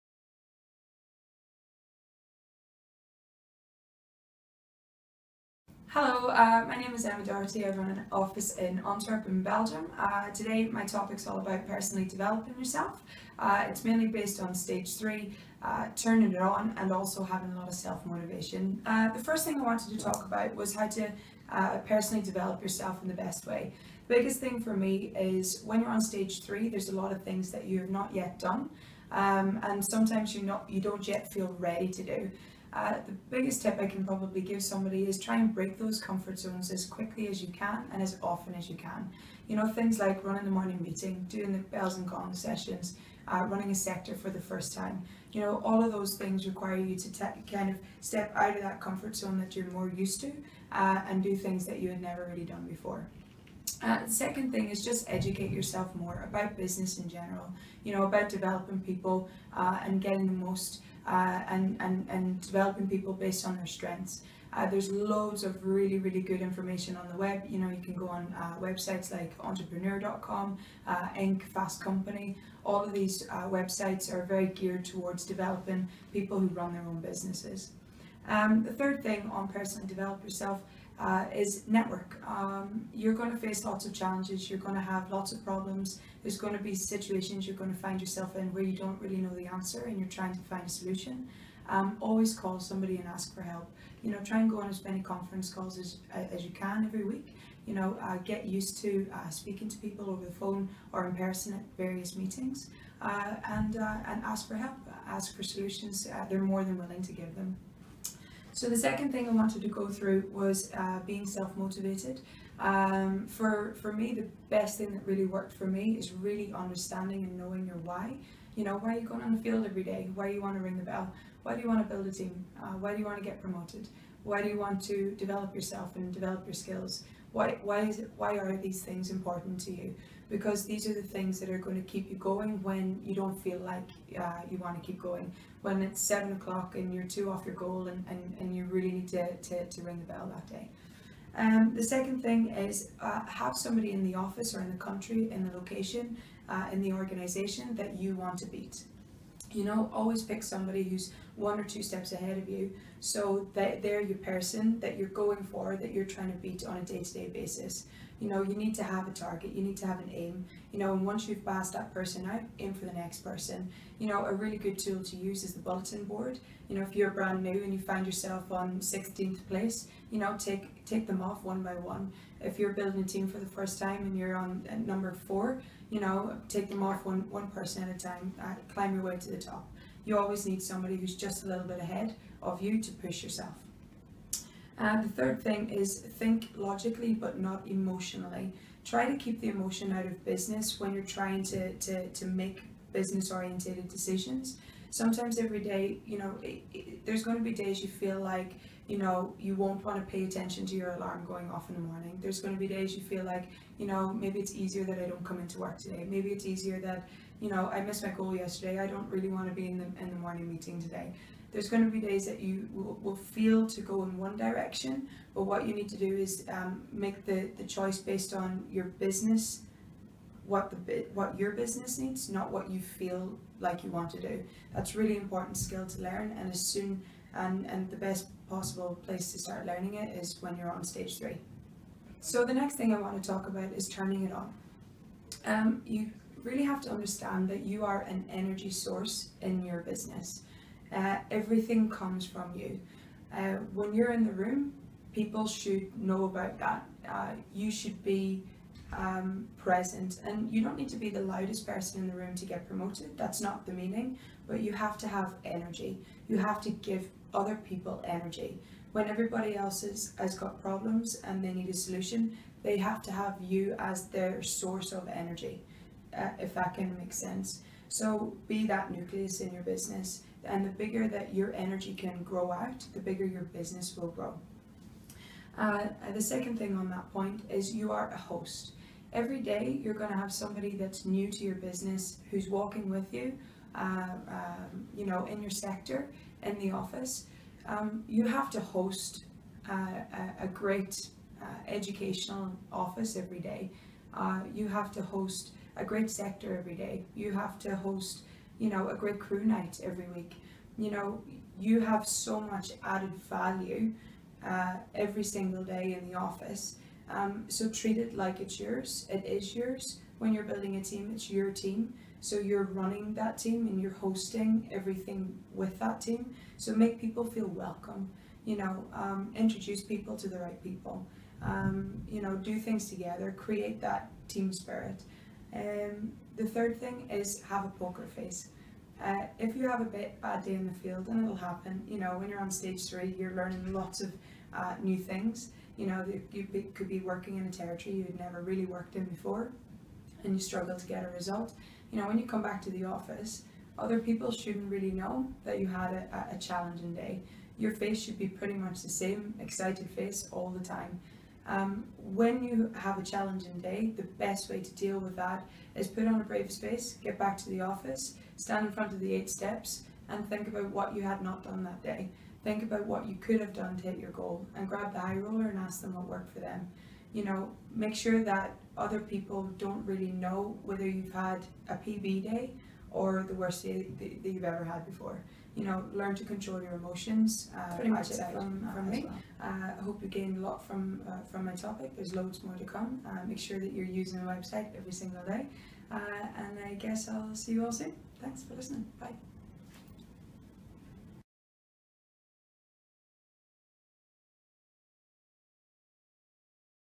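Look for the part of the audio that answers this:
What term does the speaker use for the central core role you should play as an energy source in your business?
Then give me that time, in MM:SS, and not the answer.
04:28.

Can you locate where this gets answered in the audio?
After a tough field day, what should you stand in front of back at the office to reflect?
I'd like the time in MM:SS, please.
05:59.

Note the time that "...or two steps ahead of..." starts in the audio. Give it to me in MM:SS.
02:31.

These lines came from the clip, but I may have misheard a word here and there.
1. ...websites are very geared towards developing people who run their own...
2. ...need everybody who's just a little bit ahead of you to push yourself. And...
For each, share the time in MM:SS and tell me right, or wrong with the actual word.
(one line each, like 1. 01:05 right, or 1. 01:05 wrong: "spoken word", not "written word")
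1. 01:13 right
2. 03:00 wrong: "somebody", not "everybody".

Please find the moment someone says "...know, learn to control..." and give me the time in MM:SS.
06:15.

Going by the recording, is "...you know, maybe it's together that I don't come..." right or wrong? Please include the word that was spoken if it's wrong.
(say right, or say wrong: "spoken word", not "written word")
wrong: "easier", not "together".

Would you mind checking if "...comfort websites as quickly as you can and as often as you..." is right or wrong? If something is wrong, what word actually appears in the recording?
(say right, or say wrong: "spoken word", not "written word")
wrong: "zones", not "websites".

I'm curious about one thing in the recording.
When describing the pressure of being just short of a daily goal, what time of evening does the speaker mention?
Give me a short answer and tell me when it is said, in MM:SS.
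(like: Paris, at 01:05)
7 o'clock, at 02:16.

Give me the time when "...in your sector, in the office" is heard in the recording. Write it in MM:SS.
04:45.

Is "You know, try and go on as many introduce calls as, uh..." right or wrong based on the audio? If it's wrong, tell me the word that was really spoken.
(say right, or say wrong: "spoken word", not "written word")
wrong: "conference", not "introduce".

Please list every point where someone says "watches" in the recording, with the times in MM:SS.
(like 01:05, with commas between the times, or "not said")
not said.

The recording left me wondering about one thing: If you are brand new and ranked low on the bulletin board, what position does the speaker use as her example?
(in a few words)
16th place.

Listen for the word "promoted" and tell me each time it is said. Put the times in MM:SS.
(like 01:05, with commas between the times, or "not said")
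02:03, 04:12.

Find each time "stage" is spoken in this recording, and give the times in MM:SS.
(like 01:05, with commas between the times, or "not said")
00:14, 00:25, 03:50, 05:32.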